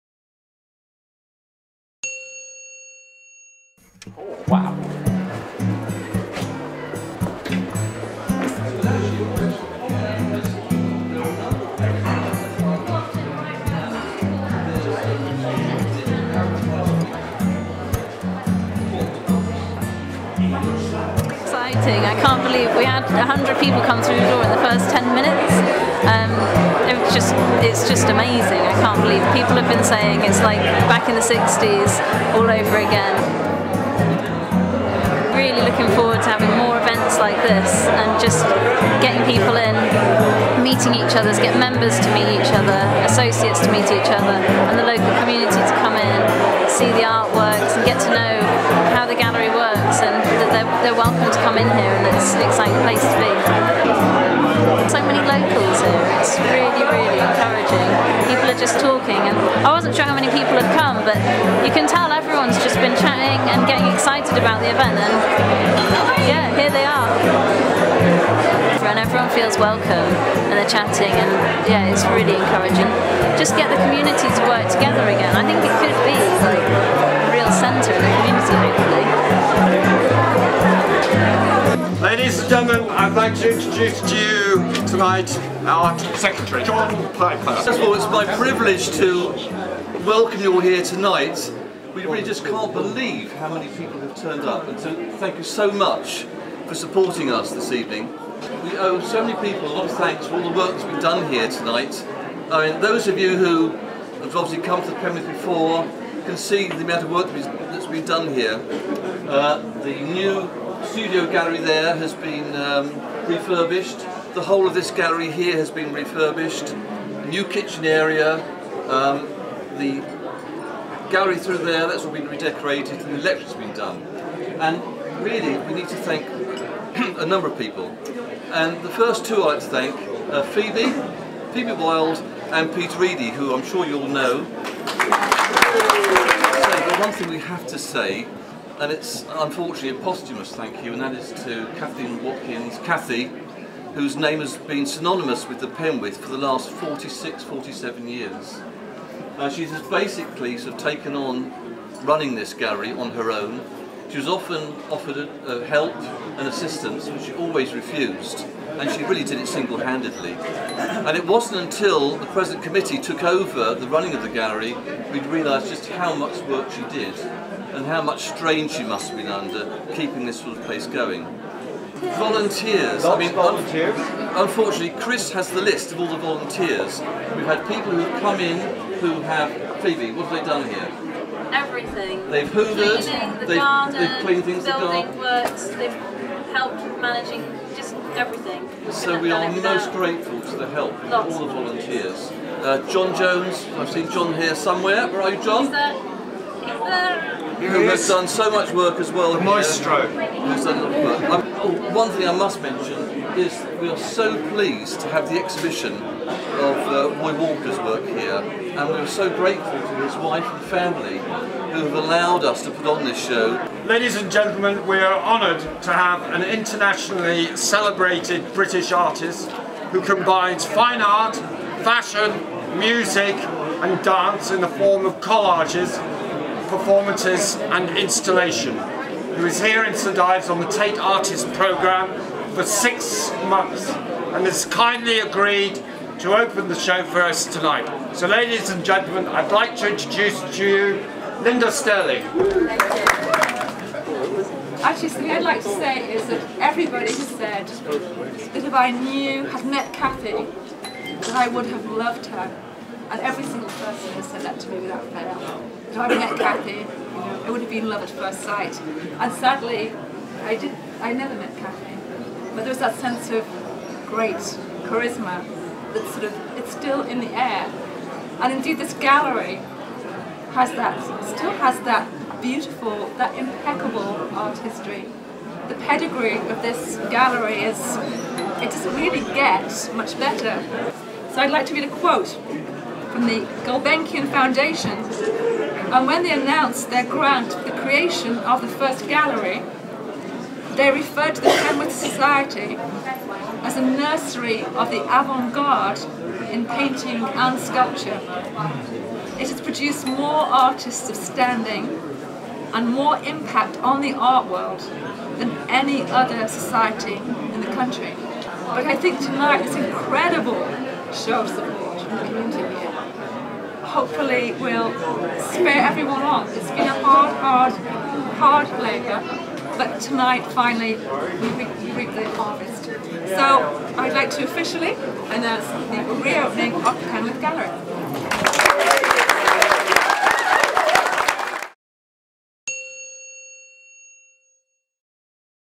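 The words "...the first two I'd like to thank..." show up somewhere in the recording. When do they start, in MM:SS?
02:08.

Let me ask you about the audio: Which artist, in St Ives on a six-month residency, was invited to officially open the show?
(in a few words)
Linder Sterling.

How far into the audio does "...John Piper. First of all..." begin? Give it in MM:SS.
01:26.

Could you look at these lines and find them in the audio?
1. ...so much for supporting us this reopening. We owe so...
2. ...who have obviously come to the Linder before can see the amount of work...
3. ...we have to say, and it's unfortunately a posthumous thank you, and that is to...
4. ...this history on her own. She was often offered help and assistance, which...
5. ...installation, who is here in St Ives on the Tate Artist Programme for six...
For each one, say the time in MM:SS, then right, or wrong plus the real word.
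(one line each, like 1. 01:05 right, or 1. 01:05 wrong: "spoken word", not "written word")
1. 01:35 wrong: "evening", not "reopening"
2. 01:43 wrong: "Premiers", not "Linder"
3. 02:17 right
4. 02:32 wrong: "gallery", not "history"
5. 03:47 right.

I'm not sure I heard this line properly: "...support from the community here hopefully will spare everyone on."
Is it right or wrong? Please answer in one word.
right.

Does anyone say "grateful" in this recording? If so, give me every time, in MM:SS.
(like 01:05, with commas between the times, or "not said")
03:09, 03:29.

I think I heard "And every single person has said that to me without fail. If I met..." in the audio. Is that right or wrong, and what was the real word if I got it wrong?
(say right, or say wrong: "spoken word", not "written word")
right.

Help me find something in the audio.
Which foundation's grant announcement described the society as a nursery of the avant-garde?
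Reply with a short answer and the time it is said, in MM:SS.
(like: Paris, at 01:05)
Gulbenkian Foundation, at 04:43.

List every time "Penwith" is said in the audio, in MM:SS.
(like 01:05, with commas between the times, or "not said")
02:25, 04:51, 05:27.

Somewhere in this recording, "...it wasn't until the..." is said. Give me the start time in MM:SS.
02:41.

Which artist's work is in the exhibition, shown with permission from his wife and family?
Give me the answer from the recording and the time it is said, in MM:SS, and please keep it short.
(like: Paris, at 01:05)
Roy Walker, at 03:27.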